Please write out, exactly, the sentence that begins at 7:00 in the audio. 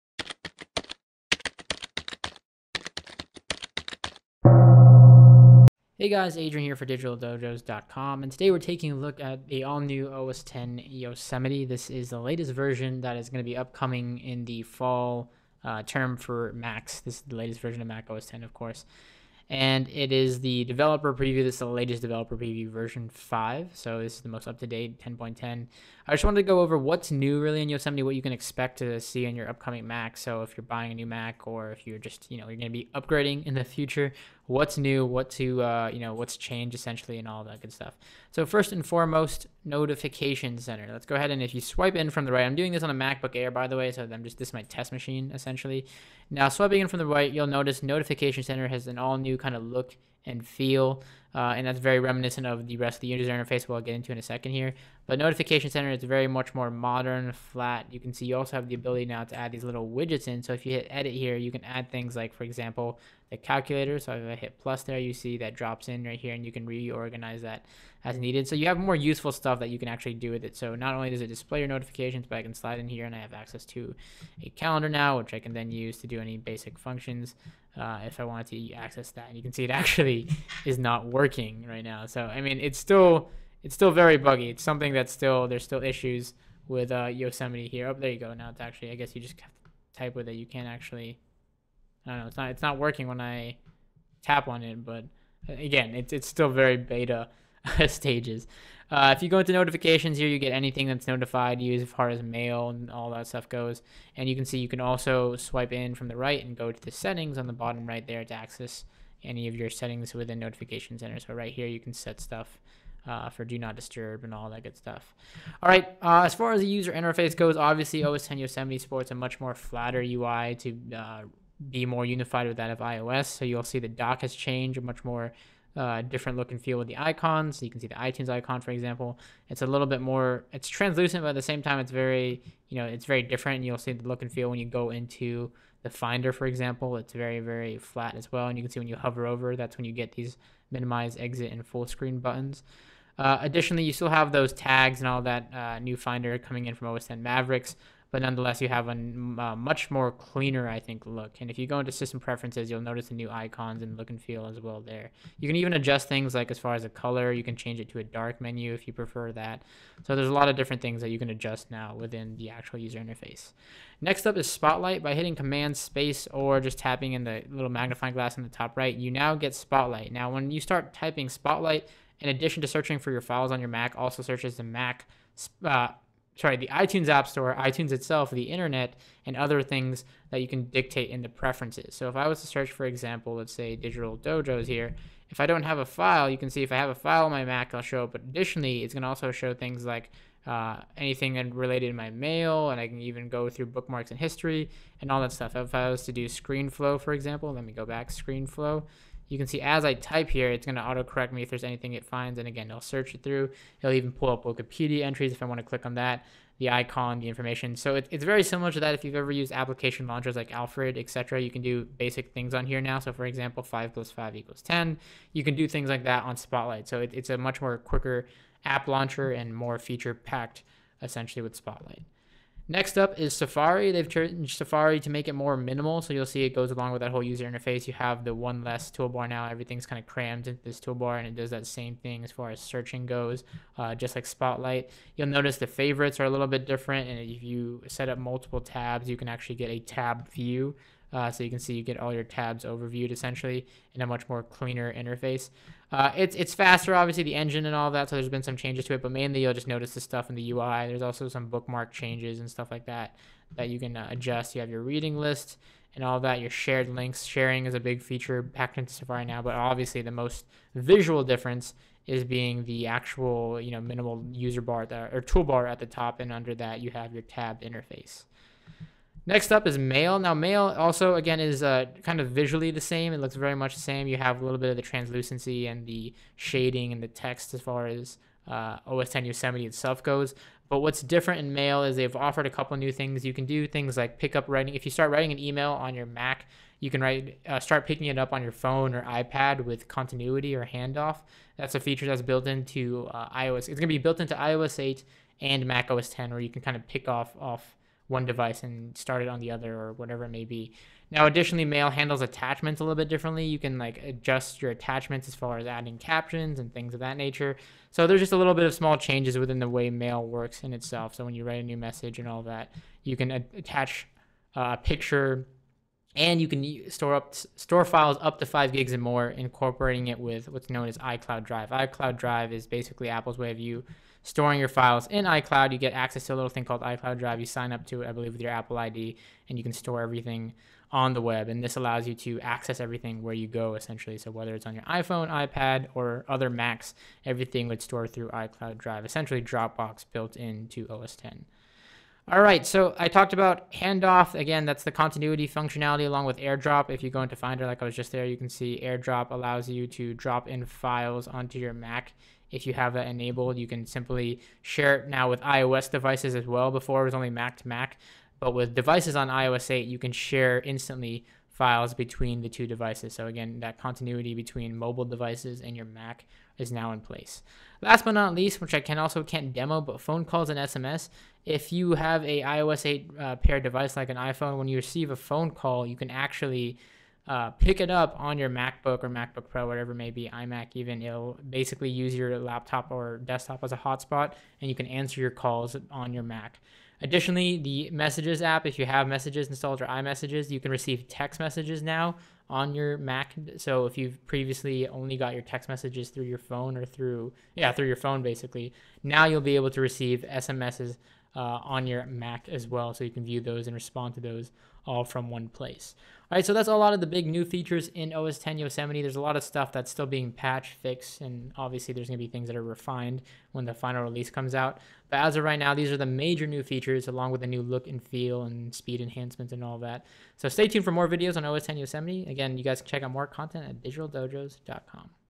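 So stay tuned for more videos on OS 10 Yosemite.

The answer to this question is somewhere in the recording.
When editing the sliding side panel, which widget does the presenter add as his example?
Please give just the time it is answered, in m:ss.
1:03.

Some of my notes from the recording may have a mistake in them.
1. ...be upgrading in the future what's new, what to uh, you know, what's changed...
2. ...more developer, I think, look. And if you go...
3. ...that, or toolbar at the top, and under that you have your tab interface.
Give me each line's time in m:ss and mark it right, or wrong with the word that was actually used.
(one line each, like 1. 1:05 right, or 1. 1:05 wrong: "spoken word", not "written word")
1. 0:32 right
2. 2:29 wrong: "cleaner", not "developer"
3. 4:24 right.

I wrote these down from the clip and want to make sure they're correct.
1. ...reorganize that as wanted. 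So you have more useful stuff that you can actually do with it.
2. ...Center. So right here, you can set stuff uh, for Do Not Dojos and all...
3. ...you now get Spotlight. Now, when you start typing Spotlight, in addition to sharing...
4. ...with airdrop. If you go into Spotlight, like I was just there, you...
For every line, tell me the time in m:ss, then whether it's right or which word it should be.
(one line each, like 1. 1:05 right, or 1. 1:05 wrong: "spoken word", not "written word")
1. 1:06 wrong: "needed", not "wanted"
2. 1:50 wrong: "Disturb", not "Dojos"
3. 2:48 wrong: "searching", not "sharing"
4. 5:46 wrong: "Finder", not "Spotlight".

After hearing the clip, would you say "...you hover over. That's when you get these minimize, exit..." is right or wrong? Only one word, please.
right.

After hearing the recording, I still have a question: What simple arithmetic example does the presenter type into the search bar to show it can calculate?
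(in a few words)
5 plus 5.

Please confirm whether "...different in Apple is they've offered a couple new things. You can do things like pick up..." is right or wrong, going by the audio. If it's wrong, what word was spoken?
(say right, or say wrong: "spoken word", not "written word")
wrong: "Mail", not "Apple".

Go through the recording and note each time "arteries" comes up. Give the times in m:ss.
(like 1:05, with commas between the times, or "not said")
not said.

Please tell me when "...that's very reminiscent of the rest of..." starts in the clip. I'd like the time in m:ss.
0:51.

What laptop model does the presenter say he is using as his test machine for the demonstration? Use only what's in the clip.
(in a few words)
MacBook Air.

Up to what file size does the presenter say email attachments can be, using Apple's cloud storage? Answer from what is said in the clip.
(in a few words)
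5 gigs.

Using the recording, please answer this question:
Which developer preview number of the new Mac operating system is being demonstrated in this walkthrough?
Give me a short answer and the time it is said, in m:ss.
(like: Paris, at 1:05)
5, at 0:22.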